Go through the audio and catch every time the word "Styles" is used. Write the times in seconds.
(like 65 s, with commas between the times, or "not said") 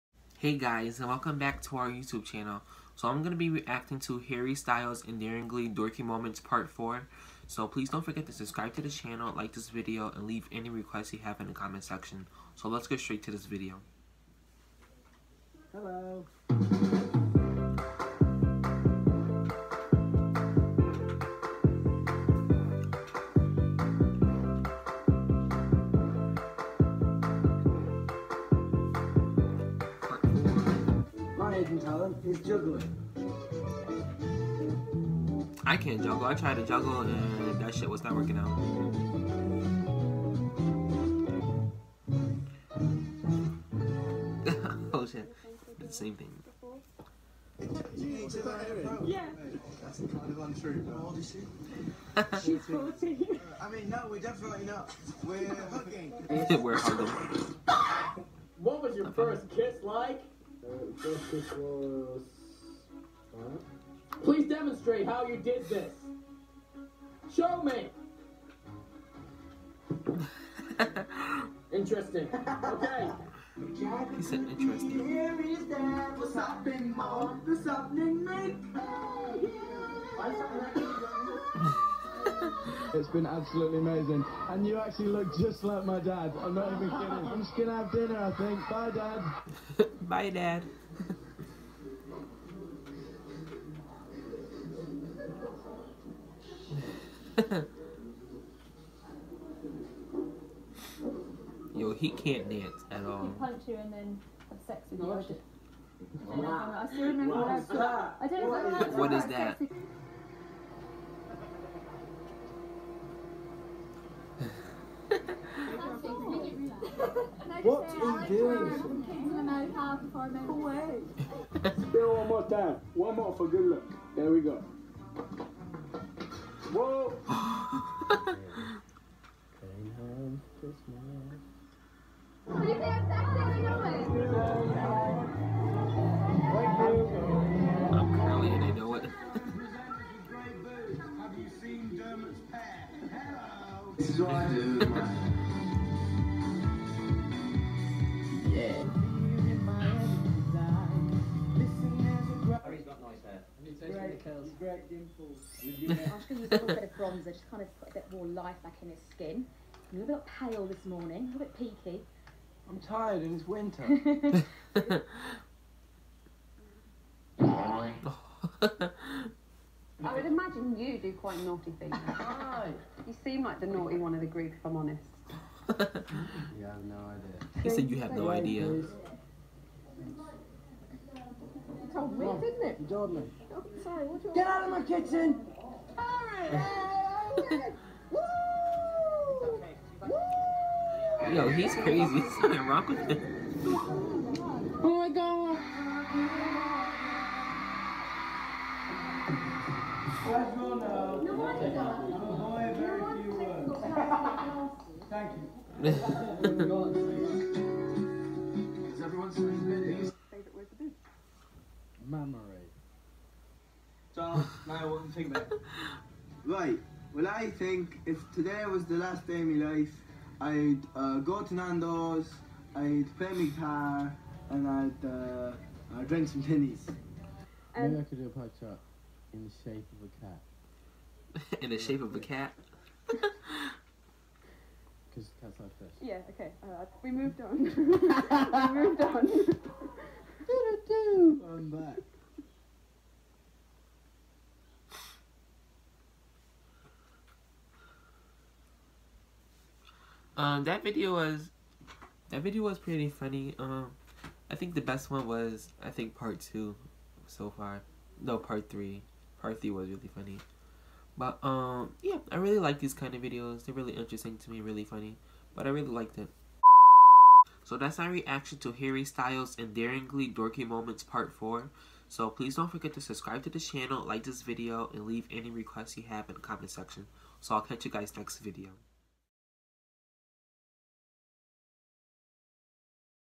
4 s, 269 s.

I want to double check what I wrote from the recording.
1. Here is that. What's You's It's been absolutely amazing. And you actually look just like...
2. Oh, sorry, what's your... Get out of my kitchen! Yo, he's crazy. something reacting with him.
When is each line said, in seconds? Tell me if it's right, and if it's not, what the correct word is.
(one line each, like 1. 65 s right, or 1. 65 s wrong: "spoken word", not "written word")
1. 75 s wrong: "What", not "You"
2. 182 s wrong: "wrong", not "reacting".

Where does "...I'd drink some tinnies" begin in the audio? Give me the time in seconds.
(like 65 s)
225 s.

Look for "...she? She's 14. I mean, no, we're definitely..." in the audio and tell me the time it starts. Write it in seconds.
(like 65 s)
51 s.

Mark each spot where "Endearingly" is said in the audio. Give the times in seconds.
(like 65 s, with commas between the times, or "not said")
5 s, 269 s.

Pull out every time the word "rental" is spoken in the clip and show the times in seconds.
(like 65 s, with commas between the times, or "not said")
not said.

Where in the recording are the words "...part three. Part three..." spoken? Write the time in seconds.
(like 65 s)
258 s.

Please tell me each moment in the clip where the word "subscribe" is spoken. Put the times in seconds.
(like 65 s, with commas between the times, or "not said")
8 s, 273 s.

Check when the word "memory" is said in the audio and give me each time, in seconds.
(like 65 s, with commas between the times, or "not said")
212 s.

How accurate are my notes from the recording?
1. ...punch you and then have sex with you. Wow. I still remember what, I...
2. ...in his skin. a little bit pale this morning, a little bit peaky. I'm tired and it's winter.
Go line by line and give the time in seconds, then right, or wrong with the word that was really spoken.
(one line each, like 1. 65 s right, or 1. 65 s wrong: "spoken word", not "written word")
1. 103 s right
2. 158 s right.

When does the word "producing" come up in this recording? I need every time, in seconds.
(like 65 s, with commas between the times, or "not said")
not said.